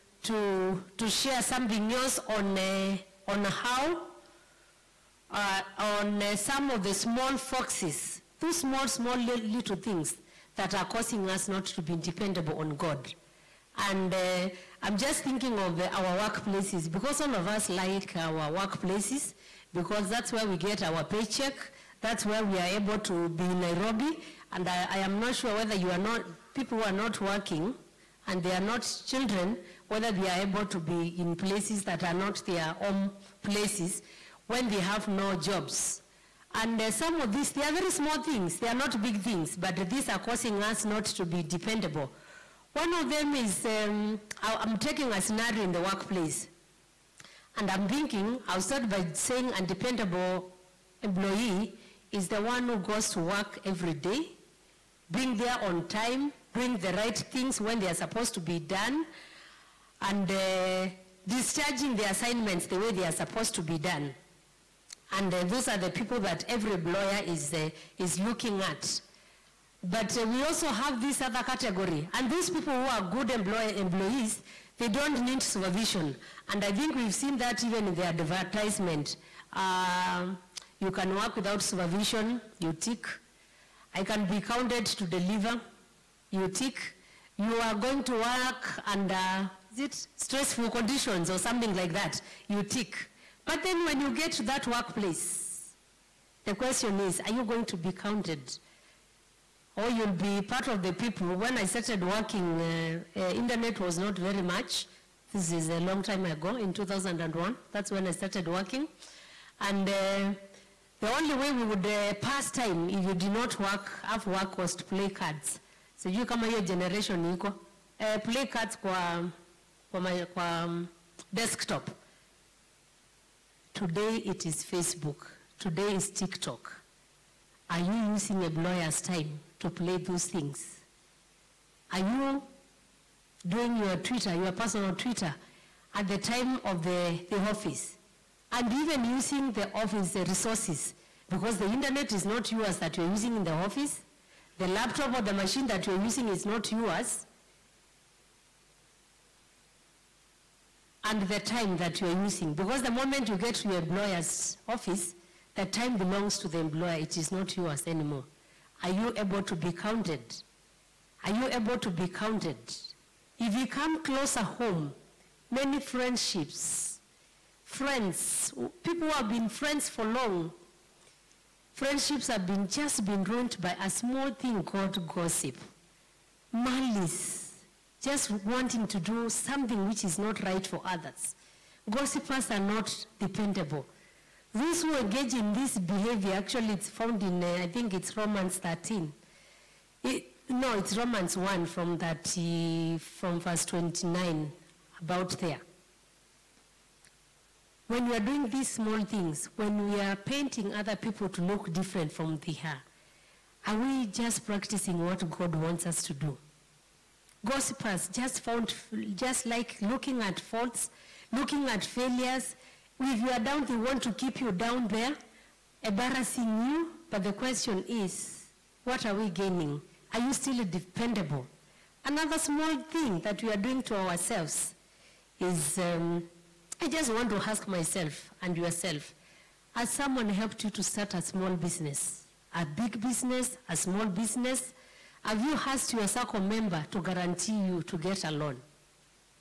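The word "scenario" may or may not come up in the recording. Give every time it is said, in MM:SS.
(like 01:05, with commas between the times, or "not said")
00:45.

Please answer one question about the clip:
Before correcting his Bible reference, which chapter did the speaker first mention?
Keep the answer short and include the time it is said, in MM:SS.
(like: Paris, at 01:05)
Romans 13, at 03:08.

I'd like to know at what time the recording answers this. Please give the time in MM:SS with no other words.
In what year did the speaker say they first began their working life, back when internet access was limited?
01:46.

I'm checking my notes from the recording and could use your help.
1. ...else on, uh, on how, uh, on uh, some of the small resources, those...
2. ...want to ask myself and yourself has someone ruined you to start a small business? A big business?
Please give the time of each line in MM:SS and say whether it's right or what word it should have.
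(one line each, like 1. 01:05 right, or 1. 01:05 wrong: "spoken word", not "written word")
1. 00:01 wrong: "foxes", not "resources"
2. 03:47 wrong: "helped", not "ruined".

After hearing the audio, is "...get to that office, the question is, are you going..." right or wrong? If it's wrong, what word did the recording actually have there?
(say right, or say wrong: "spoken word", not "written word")
wrong: "workplace", not "office".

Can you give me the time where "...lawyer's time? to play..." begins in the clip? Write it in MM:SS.
02:08.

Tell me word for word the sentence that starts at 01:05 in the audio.
And uh, those are the people that every lawyer is, uh, is looking at.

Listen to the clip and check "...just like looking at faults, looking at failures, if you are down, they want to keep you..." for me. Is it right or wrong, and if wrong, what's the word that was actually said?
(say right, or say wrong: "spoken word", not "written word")
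right.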